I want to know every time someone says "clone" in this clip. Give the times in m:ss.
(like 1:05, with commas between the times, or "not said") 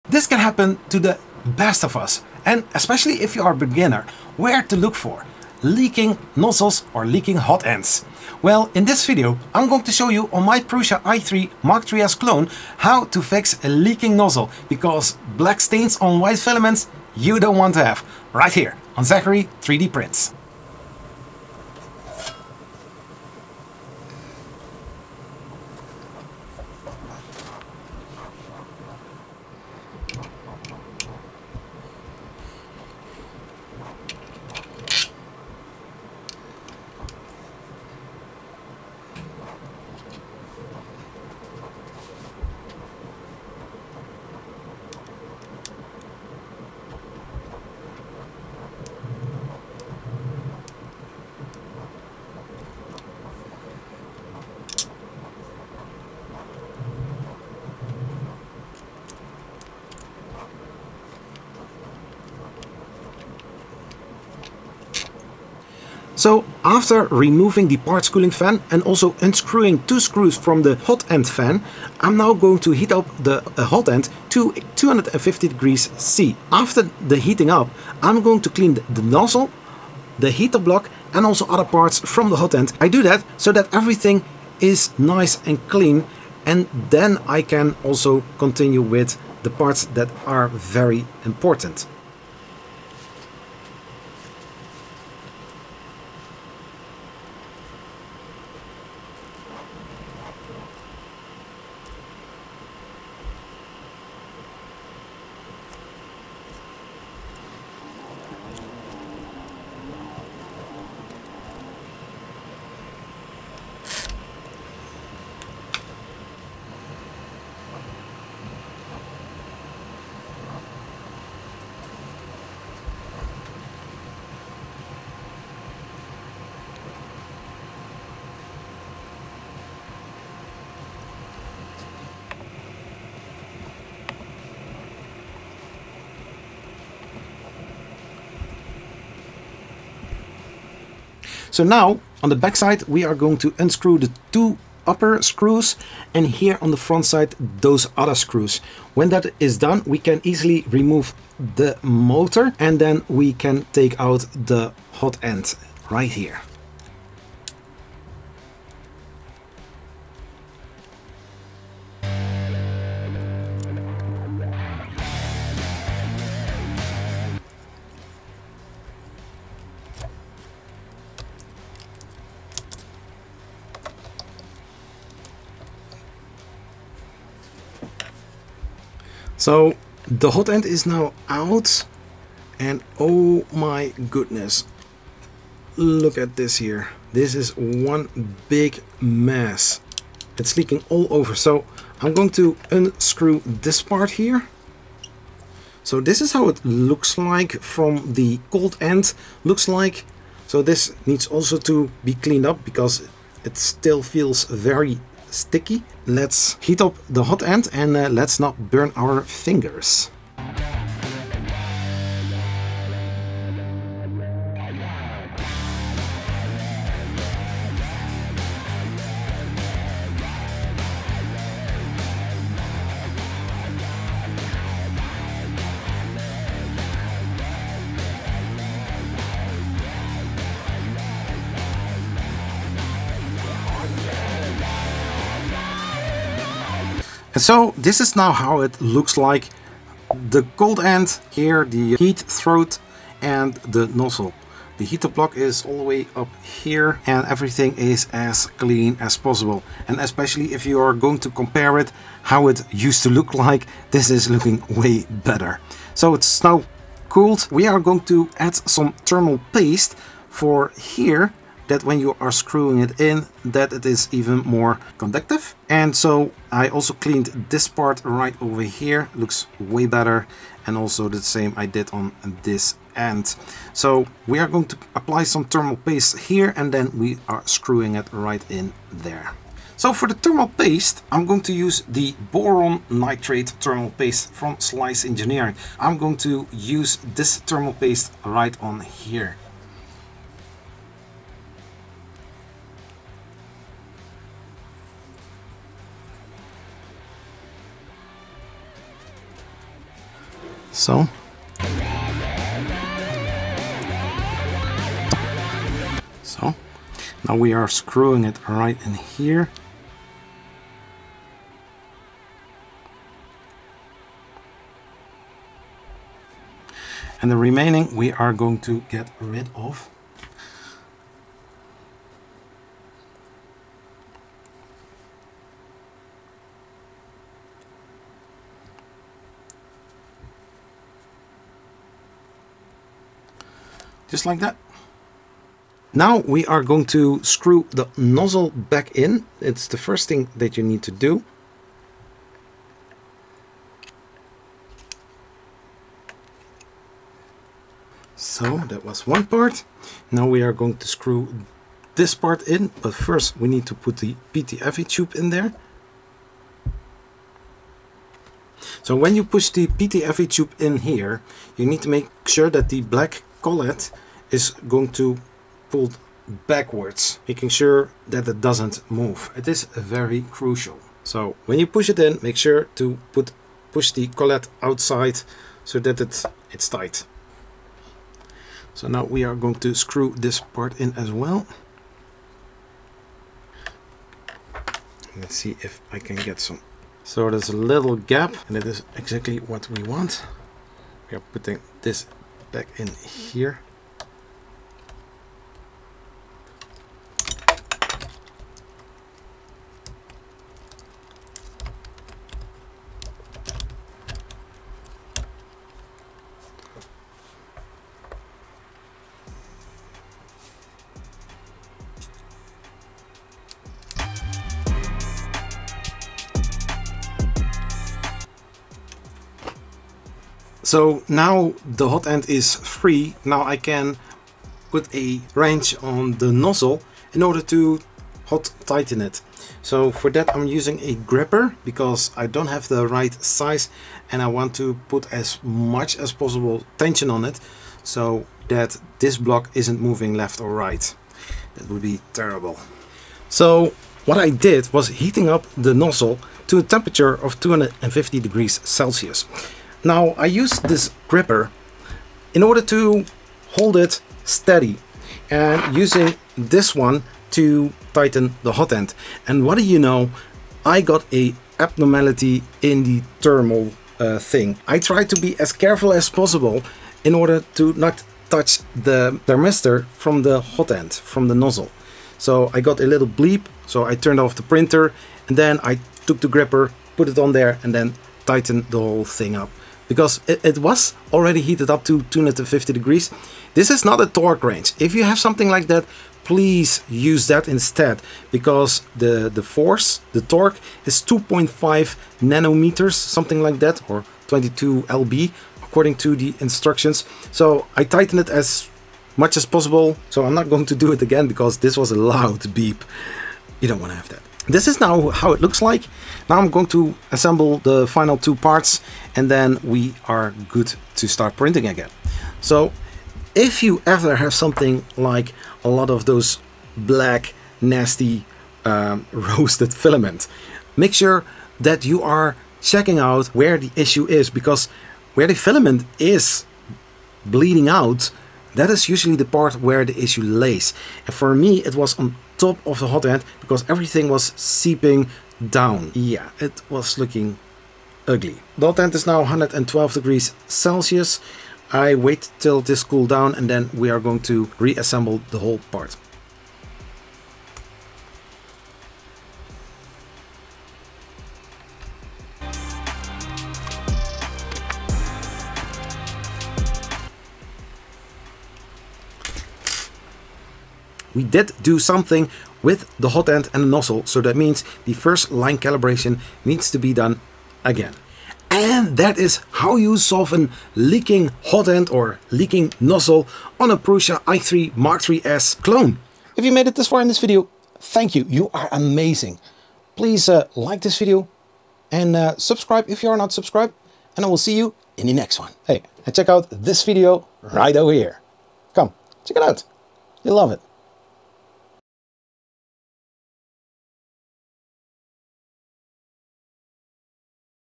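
0:12, 9:35.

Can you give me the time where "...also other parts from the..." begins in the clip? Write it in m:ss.
1:21.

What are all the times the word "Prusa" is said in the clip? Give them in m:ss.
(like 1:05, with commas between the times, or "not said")
0:10, 9:33.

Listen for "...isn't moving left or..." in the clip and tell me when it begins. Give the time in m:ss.
7:19.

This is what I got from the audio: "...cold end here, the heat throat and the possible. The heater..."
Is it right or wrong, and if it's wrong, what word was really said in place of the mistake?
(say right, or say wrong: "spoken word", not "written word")
wrong: "nozzle", not "possible".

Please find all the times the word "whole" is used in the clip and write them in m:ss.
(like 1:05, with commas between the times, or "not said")
7:58, 9:05.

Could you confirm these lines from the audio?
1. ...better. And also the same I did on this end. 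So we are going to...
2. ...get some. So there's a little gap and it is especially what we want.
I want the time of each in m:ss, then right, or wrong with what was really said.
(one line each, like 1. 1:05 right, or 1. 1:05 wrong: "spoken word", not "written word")
1. 4:29 right
2. 6:26 wrong: "exactly", not "especially".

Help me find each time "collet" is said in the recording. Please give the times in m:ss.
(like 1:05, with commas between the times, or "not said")
6:03, 6:14.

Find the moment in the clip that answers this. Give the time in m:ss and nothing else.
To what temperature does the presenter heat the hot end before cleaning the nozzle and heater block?
1:14.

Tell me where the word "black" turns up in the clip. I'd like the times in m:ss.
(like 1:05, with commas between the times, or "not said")
0:15, 6:02, 8:36.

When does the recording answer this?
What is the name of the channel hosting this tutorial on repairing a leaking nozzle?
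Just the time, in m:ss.
0:19.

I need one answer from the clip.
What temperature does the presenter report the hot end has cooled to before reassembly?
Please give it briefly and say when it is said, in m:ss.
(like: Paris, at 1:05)
112 degrees Celsius, at 8:59.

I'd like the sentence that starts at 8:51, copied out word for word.
And for me, it was on top of the hot end because everything was seeping down.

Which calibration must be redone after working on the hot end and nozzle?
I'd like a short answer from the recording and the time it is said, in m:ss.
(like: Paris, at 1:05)
first line calibration, at 9:24.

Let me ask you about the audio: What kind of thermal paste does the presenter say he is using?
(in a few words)
boron nitrate.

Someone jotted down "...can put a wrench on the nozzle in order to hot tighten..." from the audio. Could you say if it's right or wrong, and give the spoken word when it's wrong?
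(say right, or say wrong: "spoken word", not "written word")
right.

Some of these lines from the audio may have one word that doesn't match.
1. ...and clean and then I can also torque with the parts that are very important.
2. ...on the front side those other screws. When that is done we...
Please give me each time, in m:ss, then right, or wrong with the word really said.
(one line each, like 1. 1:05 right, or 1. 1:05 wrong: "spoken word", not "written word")
1. 1:25 wrong: "continue", not "torque"
2. 2:26 right.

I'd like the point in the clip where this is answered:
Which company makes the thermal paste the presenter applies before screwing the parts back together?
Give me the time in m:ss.
4:44.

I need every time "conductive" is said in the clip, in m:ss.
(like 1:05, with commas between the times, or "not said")
4:24.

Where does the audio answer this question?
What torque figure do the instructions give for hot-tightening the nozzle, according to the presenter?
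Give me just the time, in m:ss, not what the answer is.
8:11.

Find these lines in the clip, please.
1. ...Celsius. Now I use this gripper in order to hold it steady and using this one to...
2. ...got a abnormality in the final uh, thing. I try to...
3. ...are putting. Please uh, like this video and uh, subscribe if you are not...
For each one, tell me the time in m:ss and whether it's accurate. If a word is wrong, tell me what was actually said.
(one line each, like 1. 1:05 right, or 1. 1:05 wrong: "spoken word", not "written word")
1. 7:28 right
2. 7:40 wrong: "thermal", not "final"
3. 9:38 wrong: "amazing", not "putting".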